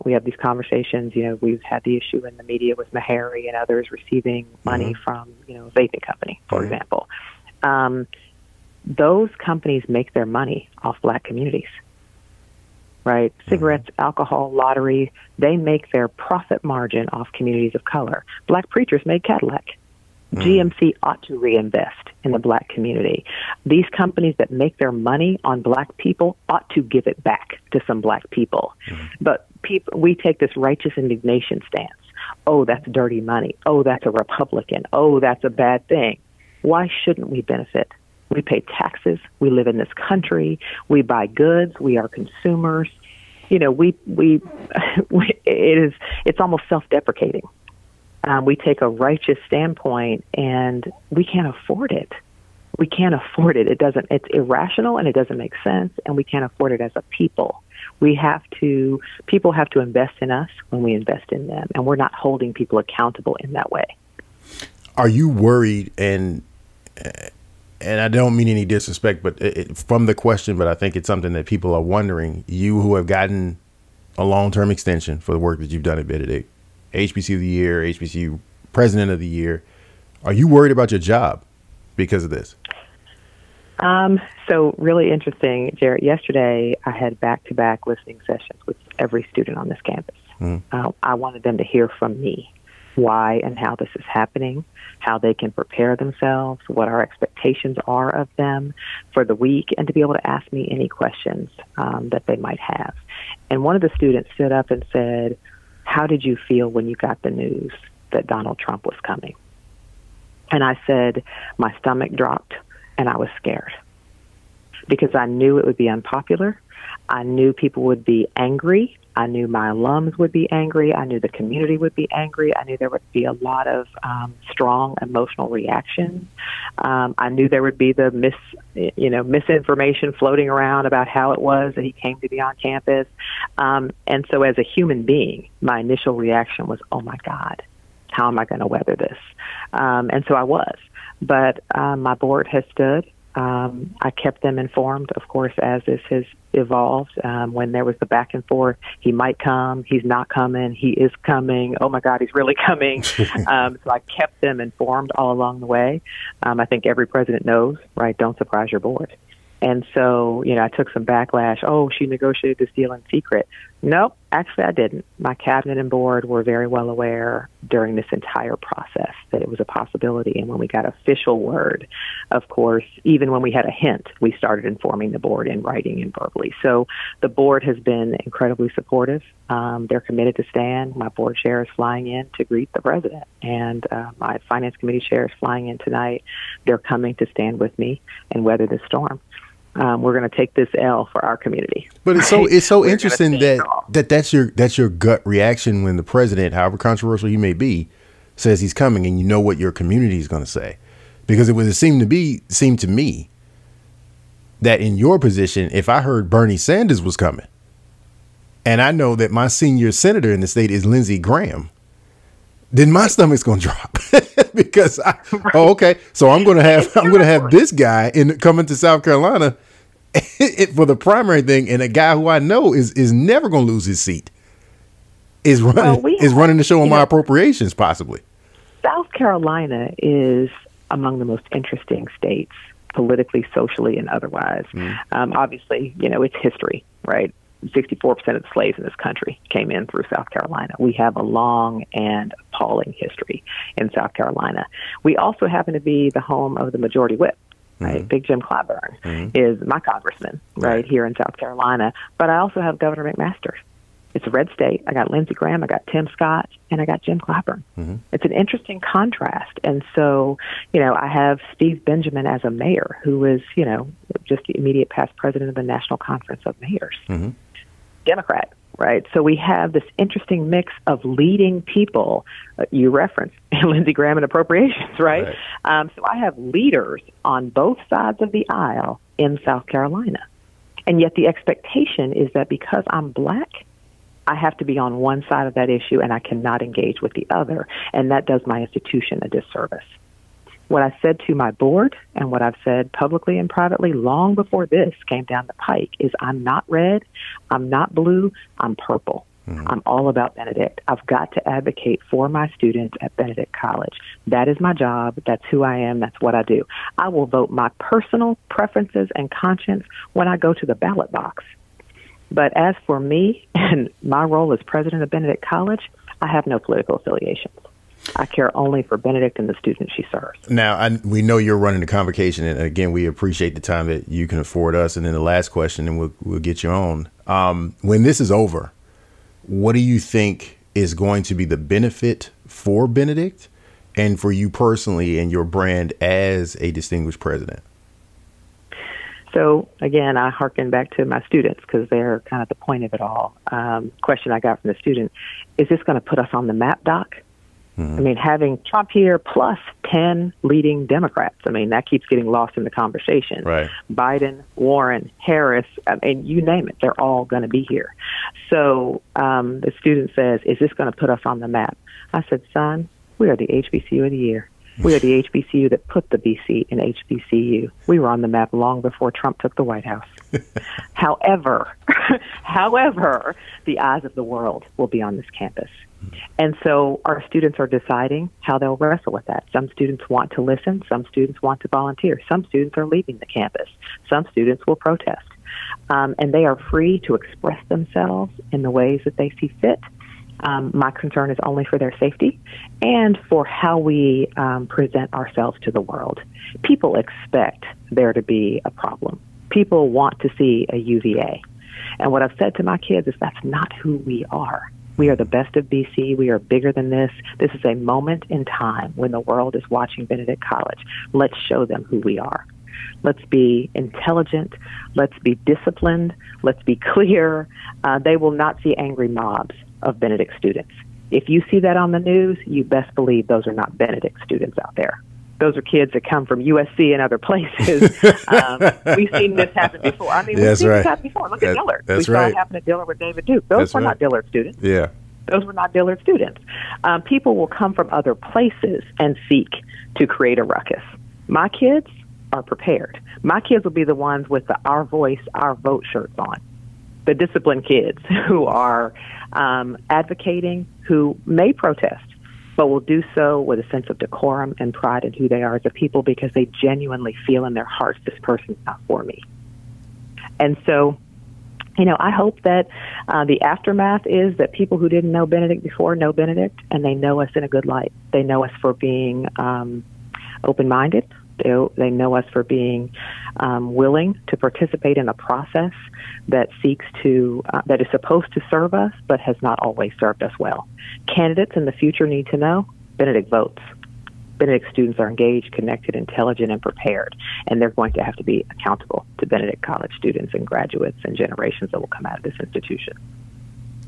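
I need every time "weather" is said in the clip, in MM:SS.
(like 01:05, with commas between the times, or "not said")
02:18, 03:08.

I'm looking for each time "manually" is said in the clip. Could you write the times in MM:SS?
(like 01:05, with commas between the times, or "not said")
not said.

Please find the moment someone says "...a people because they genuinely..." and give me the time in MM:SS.
07:35.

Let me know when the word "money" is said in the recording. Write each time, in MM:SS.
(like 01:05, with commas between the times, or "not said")
00:04, 00:10, 00:24, 00:33.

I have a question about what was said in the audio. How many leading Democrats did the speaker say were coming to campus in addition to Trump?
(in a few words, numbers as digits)
10.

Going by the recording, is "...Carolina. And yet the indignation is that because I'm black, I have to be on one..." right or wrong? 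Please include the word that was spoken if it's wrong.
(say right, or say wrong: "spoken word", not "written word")
wrong: "expectation", not "indignation".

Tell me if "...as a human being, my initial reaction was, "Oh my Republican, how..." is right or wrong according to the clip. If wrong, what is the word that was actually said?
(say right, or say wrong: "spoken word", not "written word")
wrong: "God", not "Republican".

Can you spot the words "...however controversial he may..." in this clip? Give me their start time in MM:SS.
03:16.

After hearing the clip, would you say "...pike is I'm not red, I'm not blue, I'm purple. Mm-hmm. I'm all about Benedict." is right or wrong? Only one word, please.
right.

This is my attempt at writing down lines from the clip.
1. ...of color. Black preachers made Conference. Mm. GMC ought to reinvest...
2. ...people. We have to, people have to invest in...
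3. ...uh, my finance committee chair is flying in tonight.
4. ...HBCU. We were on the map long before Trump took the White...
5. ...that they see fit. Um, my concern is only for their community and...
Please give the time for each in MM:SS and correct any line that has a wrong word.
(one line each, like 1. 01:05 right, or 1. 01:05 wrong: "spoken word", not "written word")
1. 00:17 wrong: "Cadillac", not "Conference"
2. 00:57 right
3. 03:03 right
4. 06:06 right
5. 06:29 wrong: "safety", not "community".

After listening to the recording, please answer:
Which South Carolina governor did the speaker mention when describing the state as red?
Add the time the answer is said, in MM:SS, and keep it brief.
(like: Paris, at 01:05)
McMaster, at 04:12.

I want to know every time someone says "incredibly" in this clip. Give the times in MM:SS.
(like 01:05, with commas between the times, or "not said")
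02:58.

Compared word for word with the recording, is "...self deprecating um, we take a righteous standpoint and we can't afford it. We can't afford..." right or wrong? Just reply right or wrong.
right.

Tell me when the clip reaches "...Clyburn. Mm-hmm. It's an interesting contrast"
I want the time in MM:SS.
04:17.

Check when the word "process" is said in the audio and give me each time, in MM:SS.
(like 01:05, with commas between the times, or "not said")
02:48, 07:55.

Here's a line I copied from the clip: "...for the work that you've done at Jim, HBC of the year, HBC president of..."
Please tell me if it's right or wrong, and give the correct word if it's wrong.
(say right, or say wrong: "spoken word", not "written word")
wrong: "Benedict", not "Jim".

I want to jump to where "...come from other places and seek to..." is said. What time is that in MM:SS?
07:17.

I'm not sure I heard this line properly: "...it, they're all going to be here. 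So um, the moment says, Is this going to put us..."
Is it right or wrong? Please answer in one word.
wrong.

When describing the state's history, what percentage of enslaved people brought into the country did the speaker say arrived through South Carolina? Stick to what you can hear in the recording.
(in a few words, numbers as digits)
64%.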